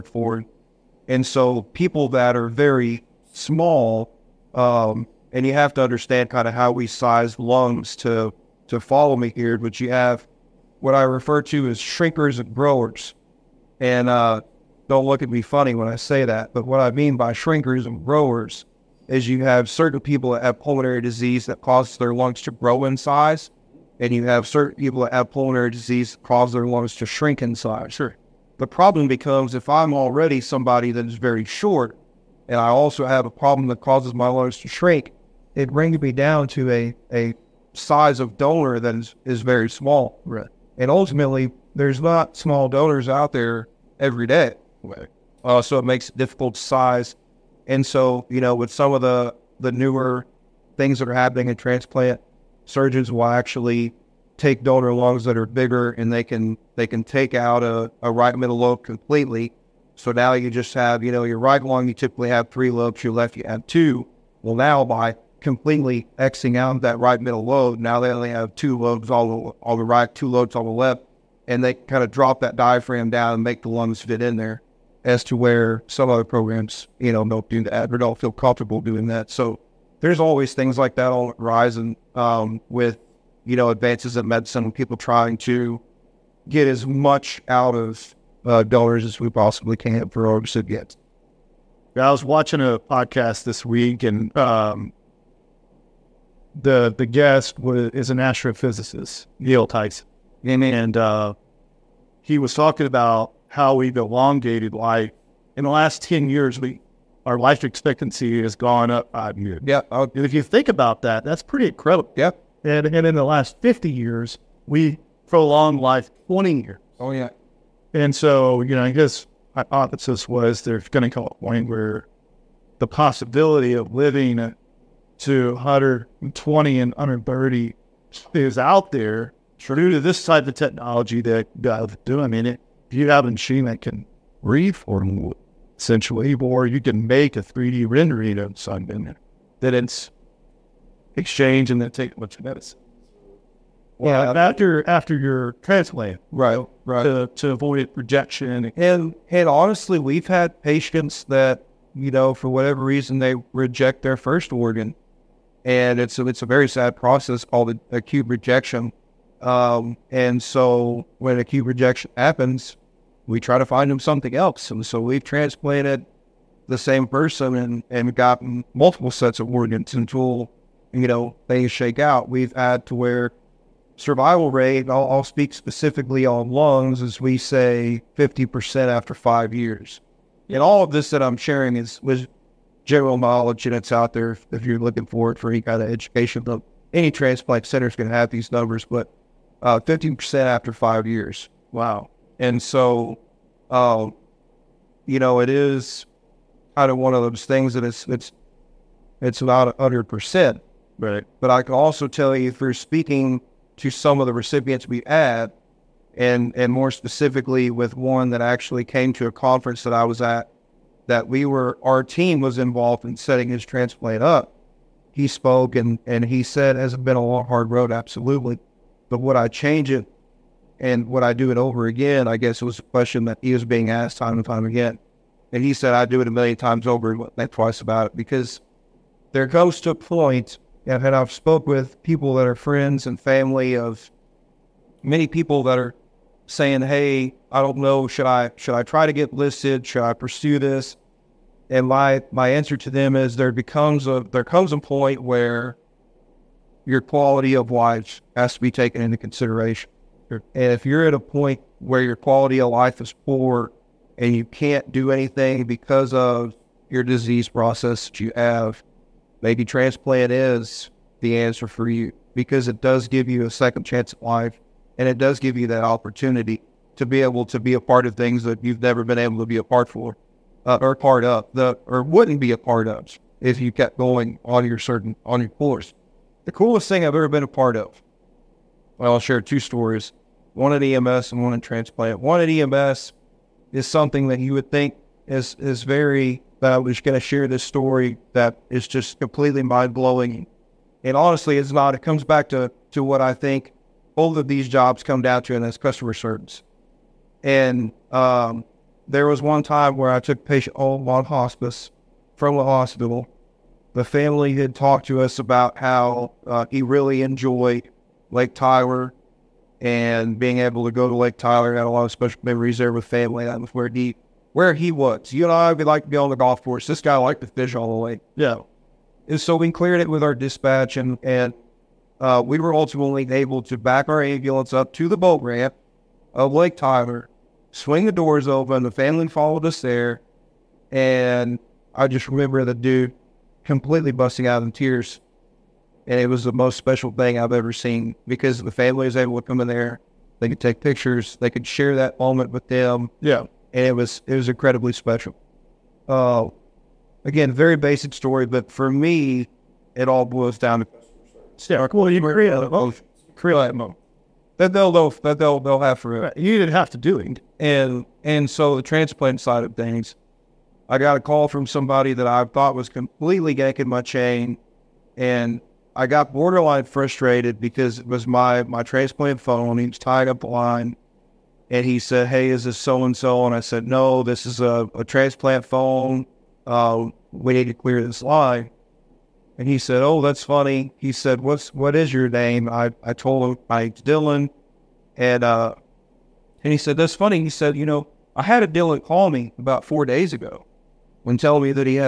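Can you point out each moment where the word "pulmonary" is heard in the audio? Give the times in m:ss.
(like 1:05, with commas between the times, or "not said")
0:20, 0:25.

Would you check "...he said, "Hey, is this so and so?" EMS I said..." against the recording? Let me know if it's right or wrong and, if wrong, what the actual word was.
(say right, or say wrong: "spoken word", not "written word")
wrong: "And", not "EMS".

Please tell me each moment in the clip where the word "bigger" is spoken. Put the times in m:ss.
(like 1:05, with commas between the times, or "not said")
0:55.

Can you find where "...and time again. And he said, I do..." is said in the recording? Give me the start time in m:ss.
3:44.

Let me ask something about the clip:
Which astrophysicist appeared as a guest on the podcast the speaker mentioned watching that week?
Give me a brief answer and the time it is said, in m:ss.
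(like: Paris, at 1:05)
Neil Tyson, at 1:39.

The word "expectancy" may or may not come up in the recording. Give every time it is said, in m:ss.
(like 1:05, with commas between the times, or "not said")
1:47.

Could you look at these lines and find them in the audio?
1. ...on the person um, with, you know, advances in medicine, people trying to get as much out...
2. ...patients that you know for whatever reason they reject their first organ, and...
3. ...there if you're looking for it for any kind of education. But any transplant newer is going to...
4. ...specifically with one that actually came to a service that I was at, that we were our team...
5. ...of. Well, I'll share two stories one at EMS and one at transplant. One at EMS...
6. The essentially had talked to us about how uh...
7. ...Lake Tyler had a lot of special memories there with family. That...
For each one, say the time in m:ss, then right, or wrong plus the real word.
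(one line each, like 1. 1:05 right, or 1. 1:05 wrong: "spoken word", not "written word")
1. 1:21 wrong: "horizon", not "person"
2. 2:30 right
3. 3:04 wrong: "center", not "newer"
4. 3:26 wrong: "conference", not "service"
5. 4:37 right
6. 5:03 wrong: "family", not "essentially"
7. 5:11 right.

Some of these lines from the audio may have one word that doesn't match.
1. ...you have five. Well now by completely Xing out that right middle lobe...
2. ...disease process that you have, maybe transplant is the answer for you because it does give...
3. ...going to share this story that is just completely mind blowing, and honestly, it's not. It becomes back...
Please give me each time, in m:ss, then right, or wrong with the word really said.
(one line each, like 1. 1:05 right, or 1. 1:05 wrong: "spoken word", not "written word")
1. 1:03 wrong: "two", not "five"
2. 4:17 right
3. 4:46 wrong: "comes", not "becomes".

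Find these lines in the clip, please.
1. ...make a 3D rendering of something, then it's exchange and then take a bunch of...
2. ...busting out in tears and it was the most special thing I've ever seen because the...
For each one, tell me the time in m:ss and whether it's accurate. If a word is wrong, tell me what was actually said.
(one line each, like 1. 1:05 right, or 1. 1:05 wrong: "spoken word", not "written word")
1. 2:17 right
2. 5:34 right.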